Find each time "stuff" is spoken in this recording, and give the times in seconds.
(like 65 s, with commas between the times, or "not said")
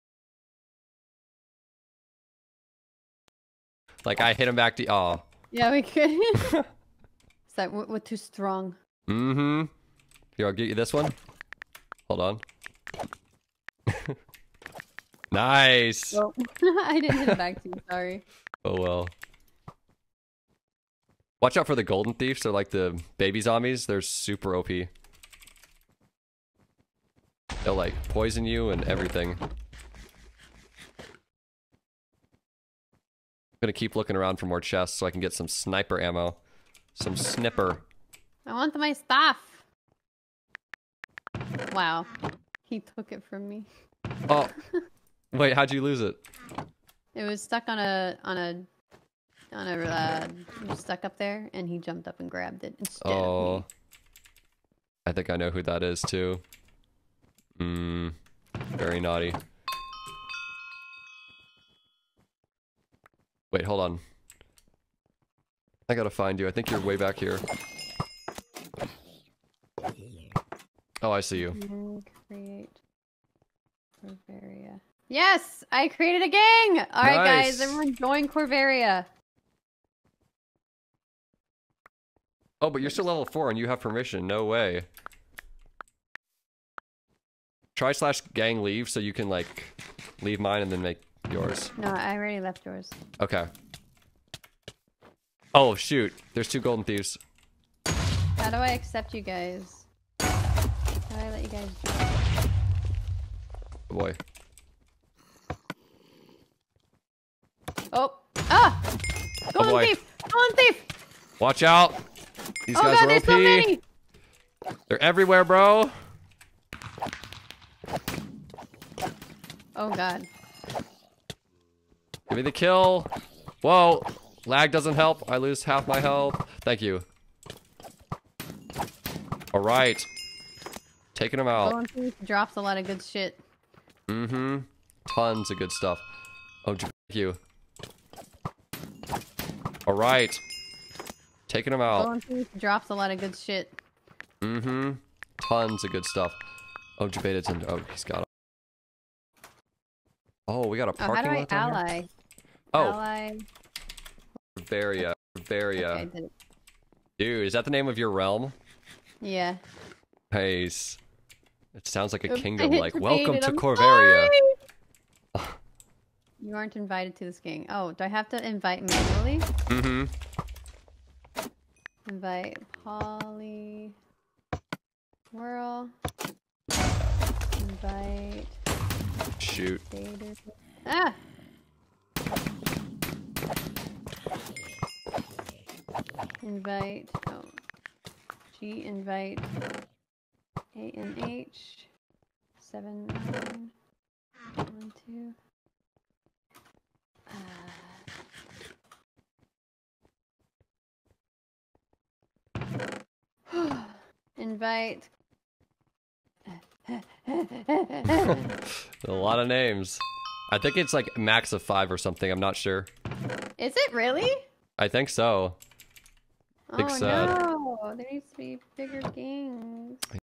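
38 s, 135 s, 146 s.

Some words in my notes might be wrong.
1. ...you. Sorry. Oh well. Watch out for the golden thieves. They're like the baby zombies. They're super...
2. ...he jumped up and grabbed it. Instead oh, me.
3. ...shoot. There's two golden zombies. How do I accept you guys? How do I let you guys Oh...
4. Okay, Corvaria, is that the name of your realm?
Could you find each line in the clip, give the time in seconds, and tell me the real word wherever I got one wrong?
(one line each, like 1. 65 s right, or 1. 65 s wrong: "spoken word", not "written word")
1. 17 s right
2. 51 s right
3. 95 s wrong: "thieves", not "zombies"
4. 155 s wrong: "Dude", not "Corvaria".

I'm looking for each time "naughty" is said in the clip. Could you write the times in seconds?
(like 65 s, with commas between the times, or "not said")
58 s.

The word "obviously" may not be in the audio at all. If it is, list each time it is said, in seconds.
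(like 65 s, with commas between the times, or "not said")
not said.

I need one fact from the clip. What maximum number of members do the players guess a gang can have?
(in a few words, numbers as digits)
5.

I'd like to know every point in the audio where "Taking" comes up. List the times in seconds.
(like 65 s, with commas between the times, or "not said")
131 s, 141 s.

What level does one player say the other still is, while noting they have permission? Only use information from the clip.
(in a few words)
4.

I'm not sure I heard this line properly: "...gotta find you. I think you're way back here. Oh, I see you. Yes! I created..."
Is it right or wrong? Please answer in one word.
right.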